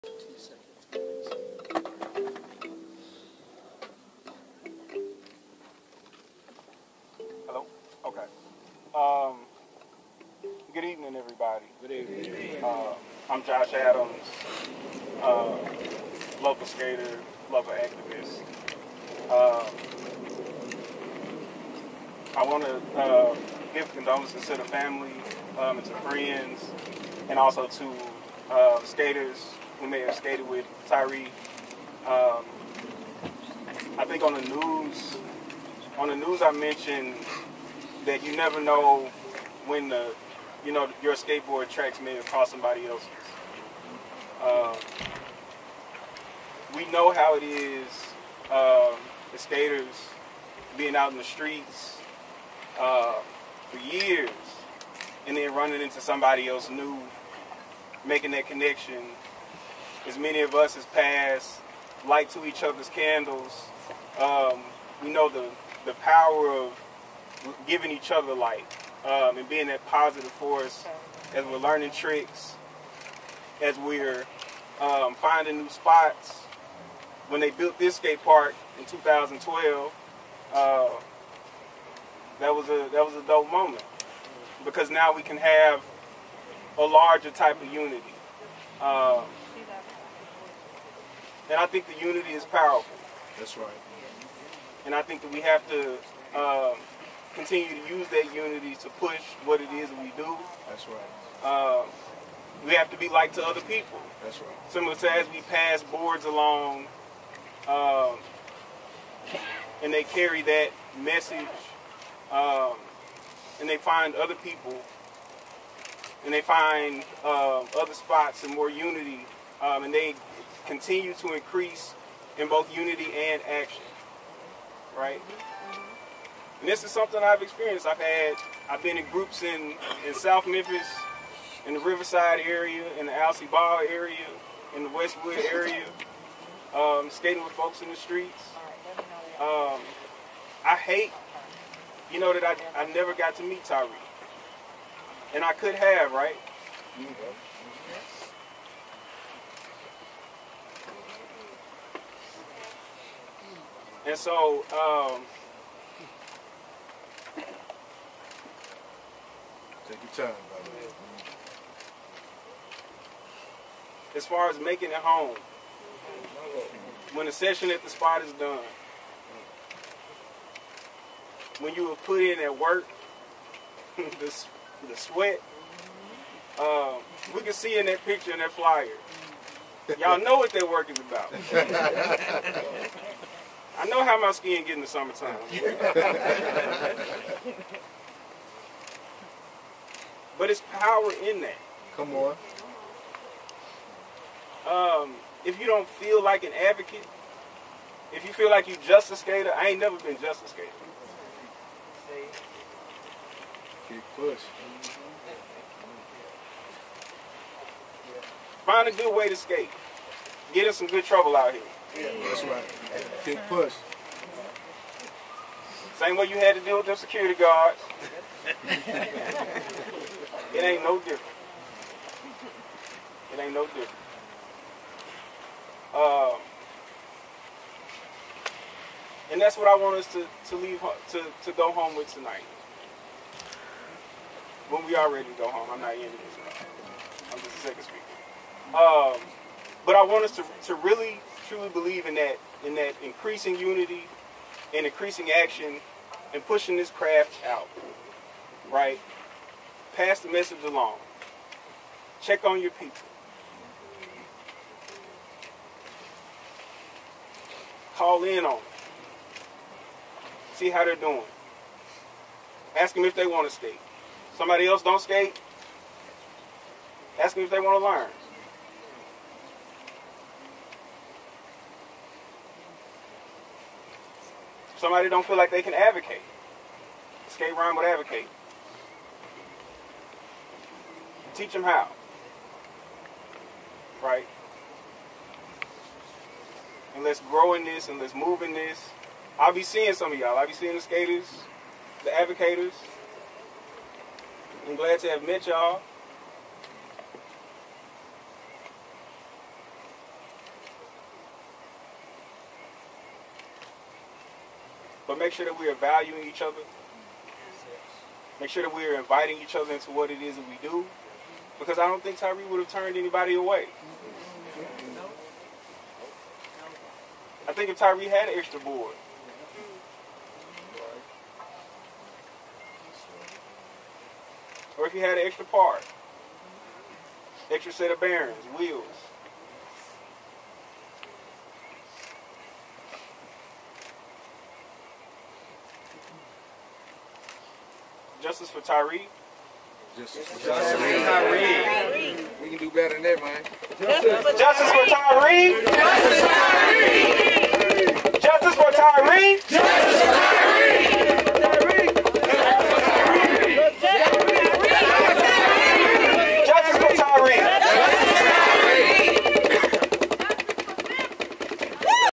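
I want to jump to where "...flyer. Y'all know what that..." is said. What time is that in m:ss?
2:58.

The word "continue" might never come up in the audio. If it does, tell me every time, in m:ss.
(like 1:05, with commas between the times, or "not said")
1:37, 2:00.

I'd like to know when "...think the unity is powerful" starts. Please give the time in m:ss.
1:31.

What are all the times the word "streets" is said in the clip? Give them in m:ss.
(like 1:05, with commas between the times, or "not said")
0:51, 2:17.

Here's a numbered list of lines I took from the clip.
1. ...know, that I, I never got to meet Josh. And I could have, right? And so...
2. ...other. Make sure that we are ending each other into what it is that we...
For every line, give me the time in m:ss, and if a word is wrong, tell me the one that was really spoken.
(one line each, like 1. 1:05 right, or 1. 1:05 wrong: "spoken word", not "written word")
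1. 2:22 wrong: "Tyre", not "Josh"
2. 5:06 wrong: "inviting", not "ending".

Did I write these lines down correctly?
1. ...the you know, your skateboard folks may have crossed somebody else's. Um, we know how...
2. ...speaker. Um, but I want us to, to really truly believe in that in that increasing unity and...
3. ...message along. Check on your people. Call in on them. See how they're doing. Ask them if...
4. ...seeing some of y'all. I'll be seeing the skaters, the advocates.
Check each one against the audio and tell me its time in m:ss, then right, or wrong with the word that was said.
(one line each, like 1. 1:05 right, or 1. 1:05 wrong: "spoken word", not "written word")
1. 0:39 wrong: "tracks", not "folks"
2. 3:57 right
3. 4:10 right
4. 4:49 right.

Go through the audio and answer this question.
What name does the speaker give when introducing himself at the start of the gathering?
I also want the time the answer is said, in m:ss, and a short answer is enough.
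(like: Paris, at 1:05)
Josh Adams, at 0:13.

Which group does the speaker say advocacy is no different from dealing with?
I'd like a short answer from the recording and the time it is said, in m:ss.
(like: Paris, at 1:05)
security guards, at 3:36.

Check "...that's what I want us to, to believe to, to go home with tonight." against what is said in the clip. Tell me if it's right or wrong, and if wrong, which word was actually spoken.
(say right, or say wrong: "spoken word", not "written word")
wrong: "leave", not "believe".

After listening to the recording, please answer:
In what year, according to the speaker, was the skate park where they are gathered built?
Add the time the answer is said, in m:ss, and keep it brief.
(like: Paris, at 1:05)
2012, at 1:18.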